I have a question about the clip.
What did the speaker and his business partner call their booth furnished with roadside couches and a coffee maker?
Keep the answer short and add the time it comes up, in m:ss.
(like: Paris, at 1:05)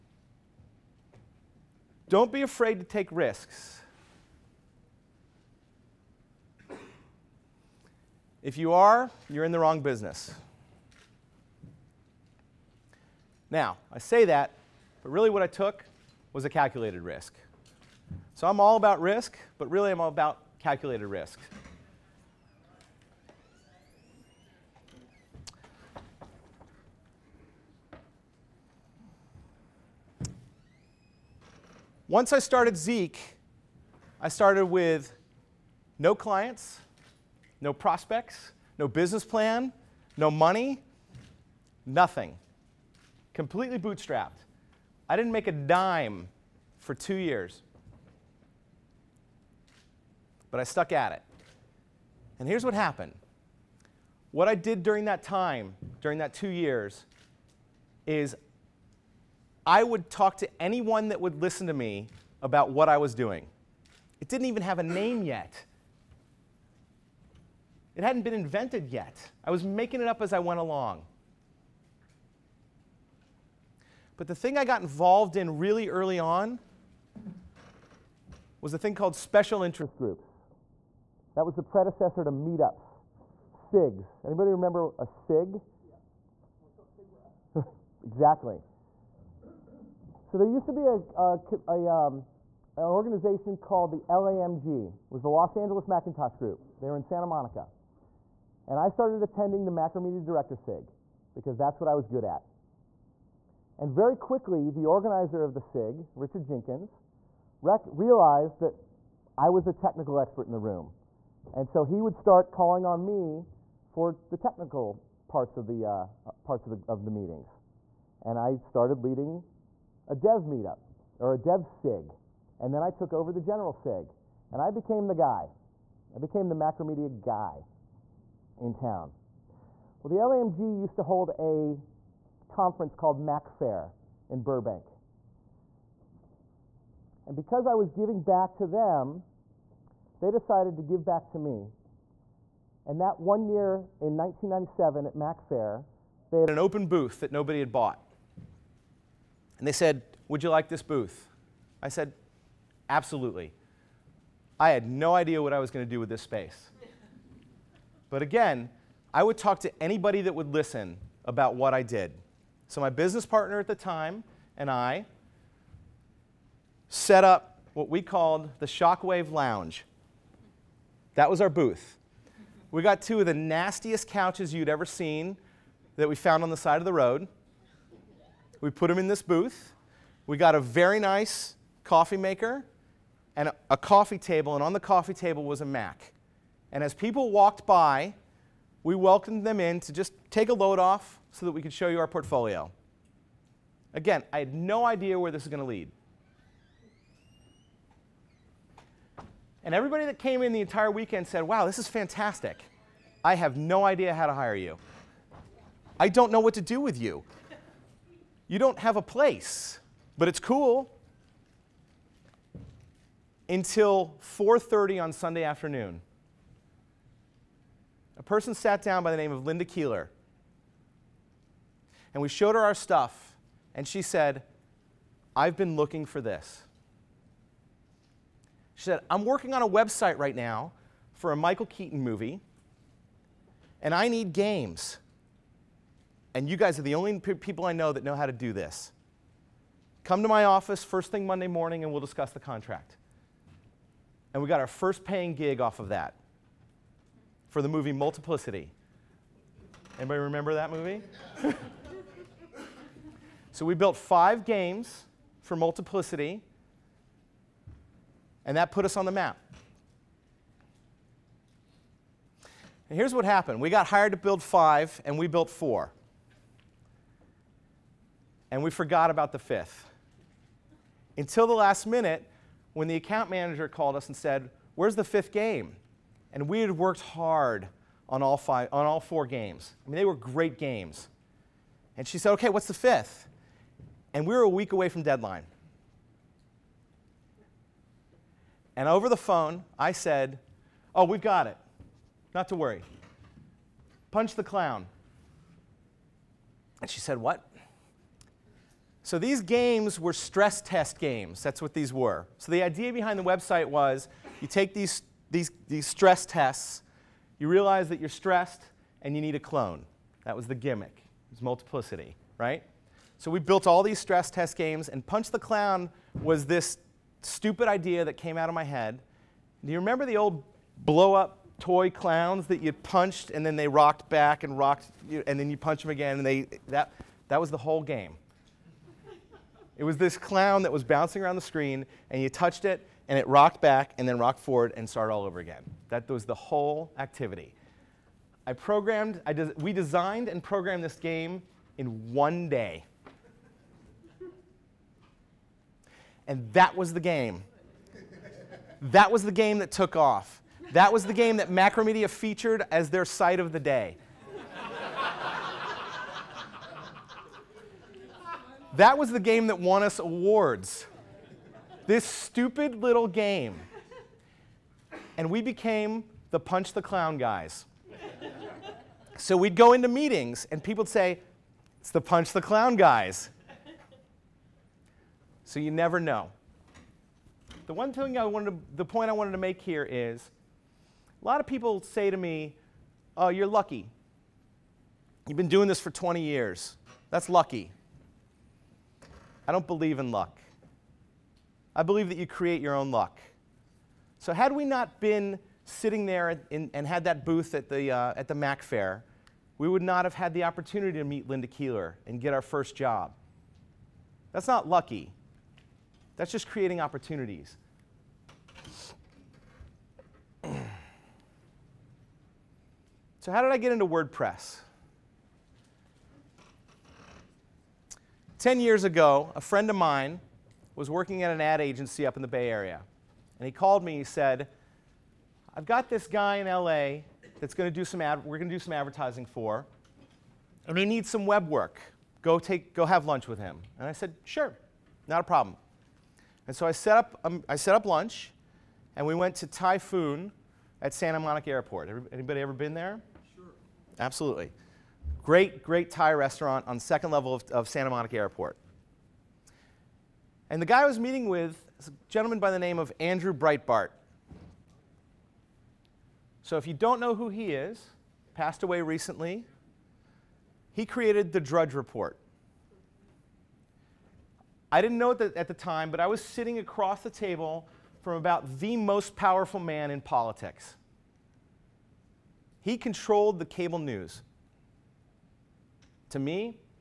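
Shockwave Lounge, at 2:48.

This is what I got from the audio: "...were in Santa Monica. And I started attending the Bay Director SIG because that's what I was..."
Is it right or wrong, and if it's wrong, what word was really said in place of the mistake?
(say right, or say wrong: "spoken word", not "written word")
wrong: "Macromedia", not "Bay".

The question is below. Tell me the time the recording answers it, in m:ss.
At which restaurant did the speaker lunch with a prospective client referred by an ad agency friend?
7:19.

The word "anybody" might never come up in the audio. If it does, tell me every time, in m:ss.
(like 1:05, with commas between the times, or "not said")
1:24, 2:39, 4:09, 7:22.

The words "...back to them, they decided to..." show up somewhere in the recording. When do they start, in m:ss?
2:18.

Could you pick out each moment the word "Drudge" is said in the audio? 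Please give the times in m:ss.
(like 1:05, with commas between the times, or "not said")
7:41.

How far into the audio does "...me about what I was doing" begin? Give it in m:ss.
1:01.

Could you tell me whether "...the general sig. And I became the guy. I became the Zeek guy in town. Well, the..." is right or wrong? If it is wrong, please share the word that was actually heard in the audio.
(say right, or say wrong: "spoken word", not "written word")
wrong: "Macromedia", not "Zeek".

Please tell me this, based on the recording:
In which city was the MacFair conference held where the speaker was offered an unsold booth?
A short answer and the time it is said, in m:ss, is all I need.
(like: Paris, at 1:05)
Burbank, at 2:14.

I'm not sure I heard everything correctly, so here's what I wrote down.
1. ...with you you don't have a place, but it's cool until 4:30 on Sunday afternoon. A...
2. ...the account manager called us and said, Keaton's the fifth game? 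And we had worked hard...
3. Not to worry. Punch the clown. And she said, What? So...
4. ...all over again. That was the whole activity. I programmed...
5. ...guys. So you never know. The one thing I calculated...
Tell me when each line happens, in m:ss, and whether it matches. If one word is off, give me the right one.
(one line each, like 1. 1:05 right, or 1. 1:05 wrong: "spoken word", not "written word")
1. 3:26 right
2. 4:32 wrong: "Where", not "Keaton"
3. 4:52 right
4. 5:35 right
5. 6:12 wrong: "wanted", not "calculated".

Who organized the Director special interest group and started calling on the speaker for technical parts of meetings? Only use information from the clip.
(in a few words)
Richard Jenkins.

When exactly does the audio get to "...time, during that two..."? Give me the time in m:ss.
0:55.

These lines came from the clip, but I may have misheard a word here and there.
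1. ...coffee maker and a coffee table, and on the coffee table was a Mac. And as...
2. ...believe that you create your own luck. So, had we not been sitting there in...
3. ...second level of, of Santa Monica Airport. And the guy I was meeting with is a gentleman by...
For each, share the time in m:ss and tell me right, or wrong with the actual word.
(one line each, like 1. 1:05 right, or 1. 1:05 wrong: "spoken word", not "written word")
1. 3:01 right
2. 6:31 right
3. 7:26 right.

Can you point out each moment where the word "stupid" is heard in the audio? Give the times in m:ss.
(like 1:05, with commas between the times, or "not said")
5:17, 6:02.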